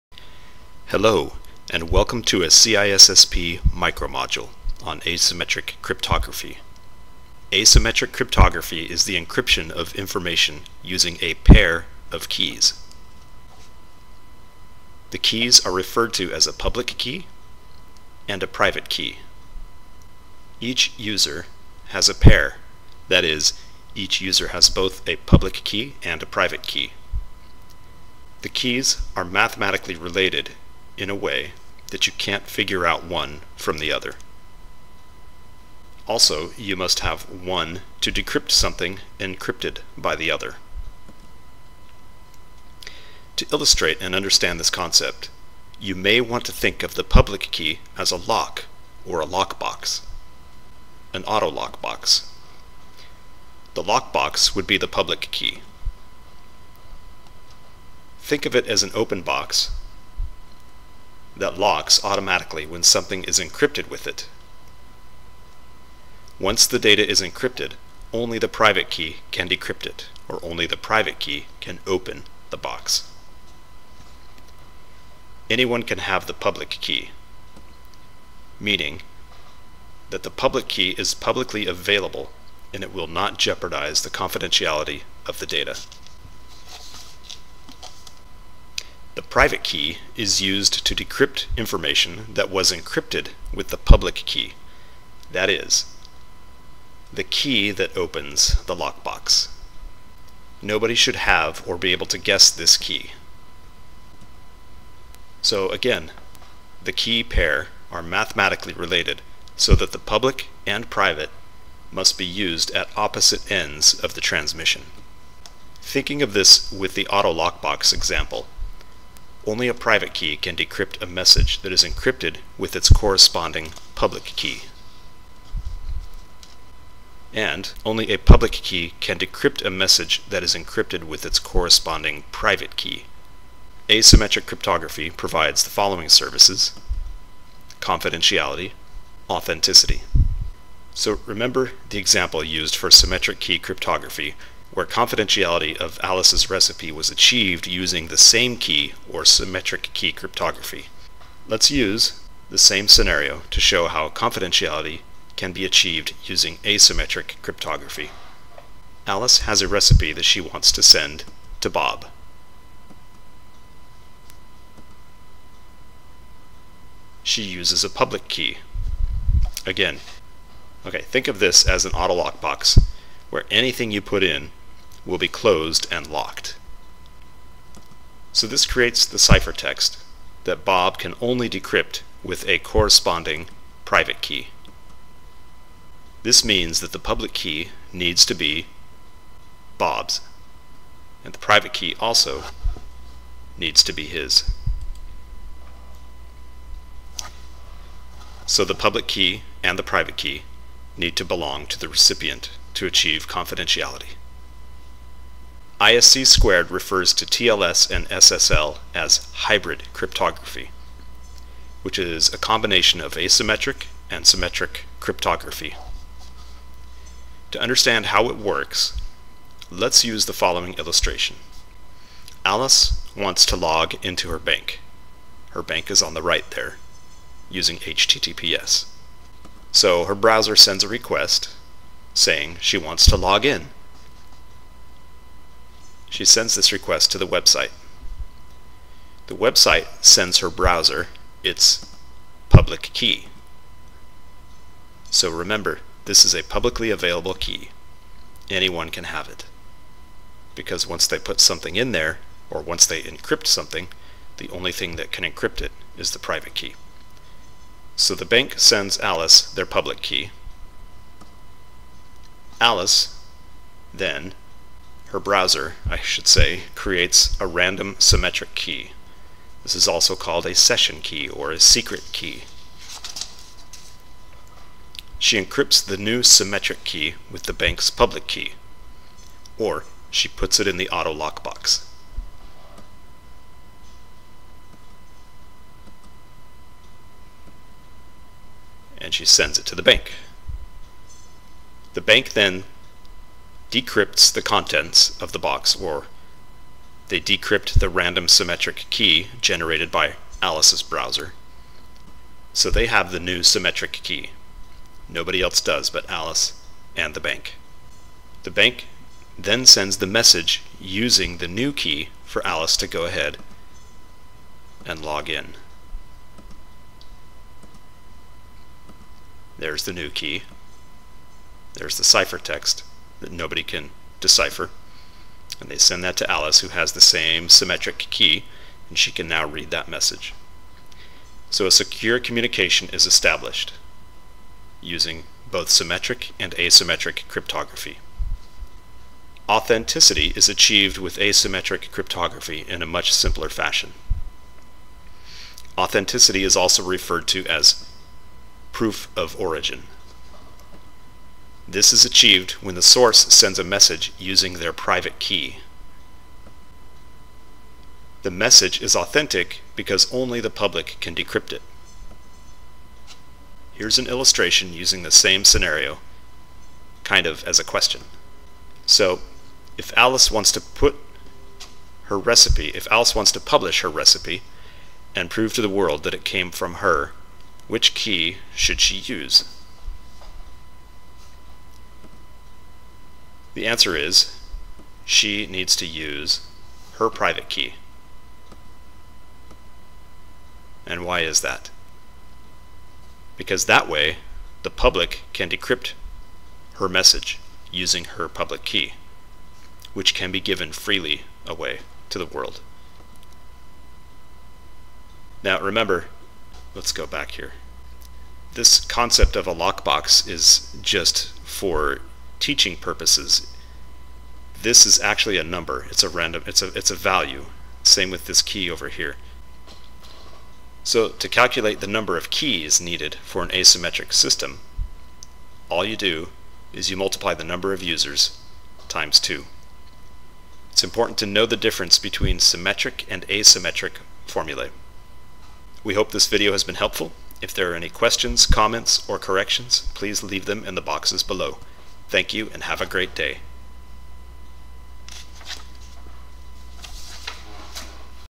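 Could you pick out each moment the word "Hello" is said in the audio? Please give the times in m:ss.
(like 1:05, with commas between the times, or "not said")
0:00.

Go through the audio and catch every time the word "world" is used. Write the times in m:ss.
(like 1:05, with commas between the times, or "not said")
6:15, 6:42.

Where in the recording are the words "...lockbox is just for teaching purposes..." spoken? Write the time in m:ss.
6:49.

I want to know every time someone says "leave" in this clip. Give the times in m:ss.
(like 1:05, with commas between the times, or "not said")
7:20.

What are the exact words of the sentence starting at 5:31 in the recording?
So a secure communication is established using both symmetric and asymmetric cryptography.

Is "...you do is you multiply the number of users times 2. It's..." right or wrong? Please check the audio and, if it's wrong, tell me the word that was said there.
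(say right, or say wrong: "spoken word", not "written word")
right.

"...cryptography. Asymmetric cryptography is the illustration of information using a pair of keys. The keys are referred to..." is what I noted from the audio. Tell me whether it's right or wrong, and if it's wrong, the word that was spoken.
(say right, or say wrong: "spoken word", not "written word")
wrong: "encryption", not "illustration".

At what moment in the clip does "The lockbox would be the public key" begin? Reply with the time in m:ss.
0:53.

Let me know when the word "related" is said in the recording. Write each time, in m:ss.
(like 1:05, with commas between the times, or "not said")
0:29, 1:48.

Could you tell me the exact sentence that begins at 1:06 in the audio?
Once the data is encrypted, only the private key can decrypt it, or only the private key can open the box.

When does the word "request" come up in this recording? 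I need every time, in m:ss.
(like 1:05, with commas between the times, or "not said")
3:50, 3:56.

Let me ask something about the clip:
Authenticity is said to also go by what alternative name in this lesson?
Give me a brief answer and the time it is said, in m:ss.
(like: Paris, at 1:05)
Proof of origin, at 5:48.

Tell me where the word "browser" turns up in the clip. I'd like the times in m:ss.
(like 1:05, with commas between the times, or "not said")
3:50, 4:00, 4:25, 5:00.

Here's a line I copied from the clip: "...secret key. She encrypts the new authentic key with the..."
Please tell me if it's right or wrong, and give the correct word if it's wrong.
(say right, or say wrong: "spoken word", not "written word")
wrong: "symmetric", not "authentic".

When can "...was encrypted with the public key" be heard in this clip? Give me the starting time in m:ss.
1:32.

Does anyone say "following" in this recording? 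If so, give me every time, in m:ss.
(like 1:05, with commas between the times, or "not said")
2:15, 3:40.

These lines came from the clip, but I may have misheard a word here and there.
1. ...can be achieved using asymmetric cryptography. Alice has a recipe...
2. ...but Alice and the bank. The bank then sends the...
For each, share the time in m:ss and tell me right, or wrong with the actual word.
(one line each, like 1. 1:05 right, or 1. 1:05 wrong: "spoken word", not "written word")
1. 2:35 right
2. 5:05 right.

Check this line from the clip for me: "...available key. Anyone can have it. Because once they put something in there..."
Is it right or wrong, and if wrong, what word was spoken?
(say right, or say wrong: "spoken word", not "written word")
right.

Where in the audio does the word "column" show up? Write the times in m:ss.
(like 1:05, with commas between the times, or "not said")
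not said.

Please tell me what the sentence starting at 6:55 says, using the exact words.
It's a random, it's a, it's a value.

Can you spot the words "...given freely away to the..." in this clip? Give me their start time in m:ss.
6:40.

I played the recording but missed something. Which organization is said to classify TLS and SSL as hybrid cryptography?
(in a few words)
ISC squared.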